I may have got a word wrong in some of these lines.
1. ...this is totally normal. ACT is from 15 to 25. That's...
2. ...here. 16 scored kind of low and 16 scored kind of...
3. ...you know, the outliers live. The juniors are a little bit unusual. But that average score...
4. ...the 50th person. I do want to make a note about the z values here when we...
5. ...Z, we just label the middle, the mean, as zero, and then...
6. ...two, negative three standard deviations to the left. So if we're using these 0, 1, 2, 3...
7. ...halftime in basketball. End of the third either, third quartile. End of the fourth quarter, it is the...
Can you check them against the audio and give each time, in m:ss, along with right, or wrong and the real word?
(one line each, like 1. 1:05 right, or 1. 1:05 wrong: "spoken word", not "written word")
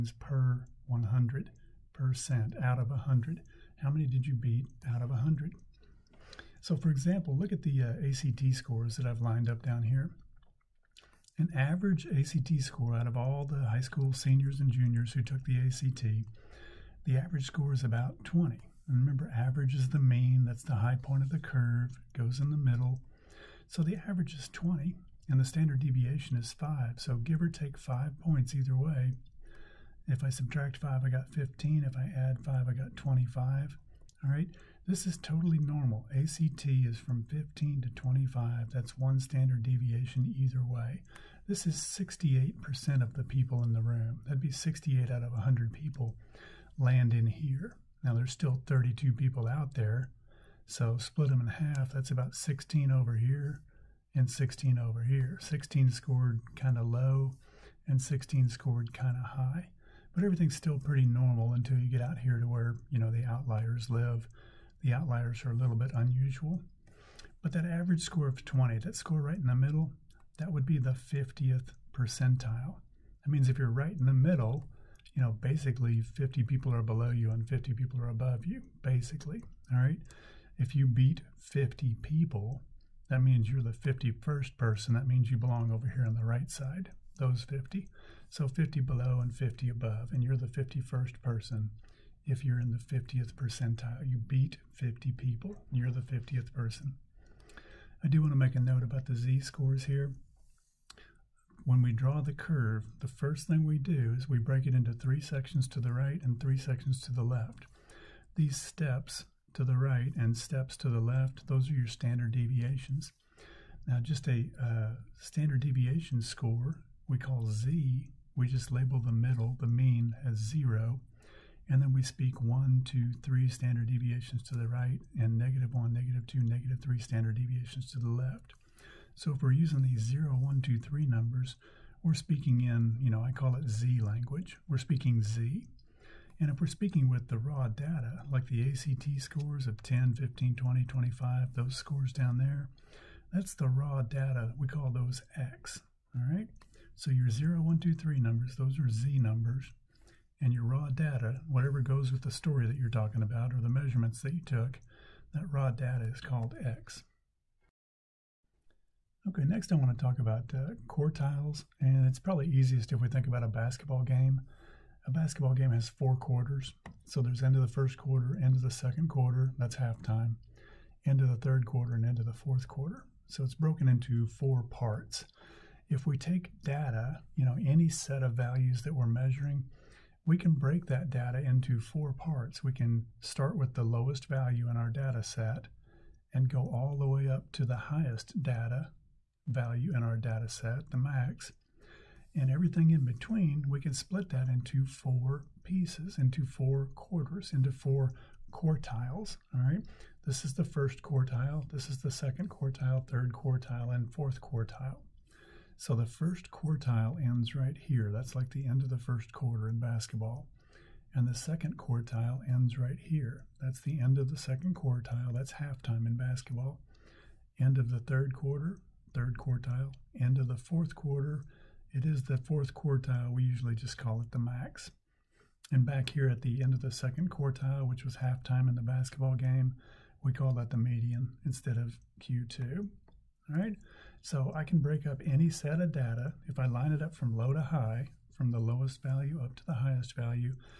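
1. 0:34 right
2. 0:55 right
3. 1:02 wrong: "outliers", not "juniors"
4. 1:35 wrong: "scores", not "values"
5. 1:57 right
6. 2:06 right
7. 3:35 wrong: "quarter", not "either".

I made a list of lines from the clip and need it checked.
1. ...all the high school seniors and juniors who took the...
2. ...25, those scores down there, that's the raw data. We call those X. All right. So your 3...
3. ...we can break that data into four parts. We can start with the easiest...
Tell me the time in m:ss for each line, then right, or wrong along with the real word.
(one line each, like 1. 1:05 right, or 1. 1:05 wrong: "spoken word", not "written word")
1. 0:13 right
2. 2:20 wrong: "0", not "3"
3. 3:00 wrong: "lowest", not "easiest".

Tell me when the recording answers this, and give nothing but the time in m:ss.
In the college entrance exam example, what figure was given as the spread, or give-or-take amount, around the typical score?
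0:25.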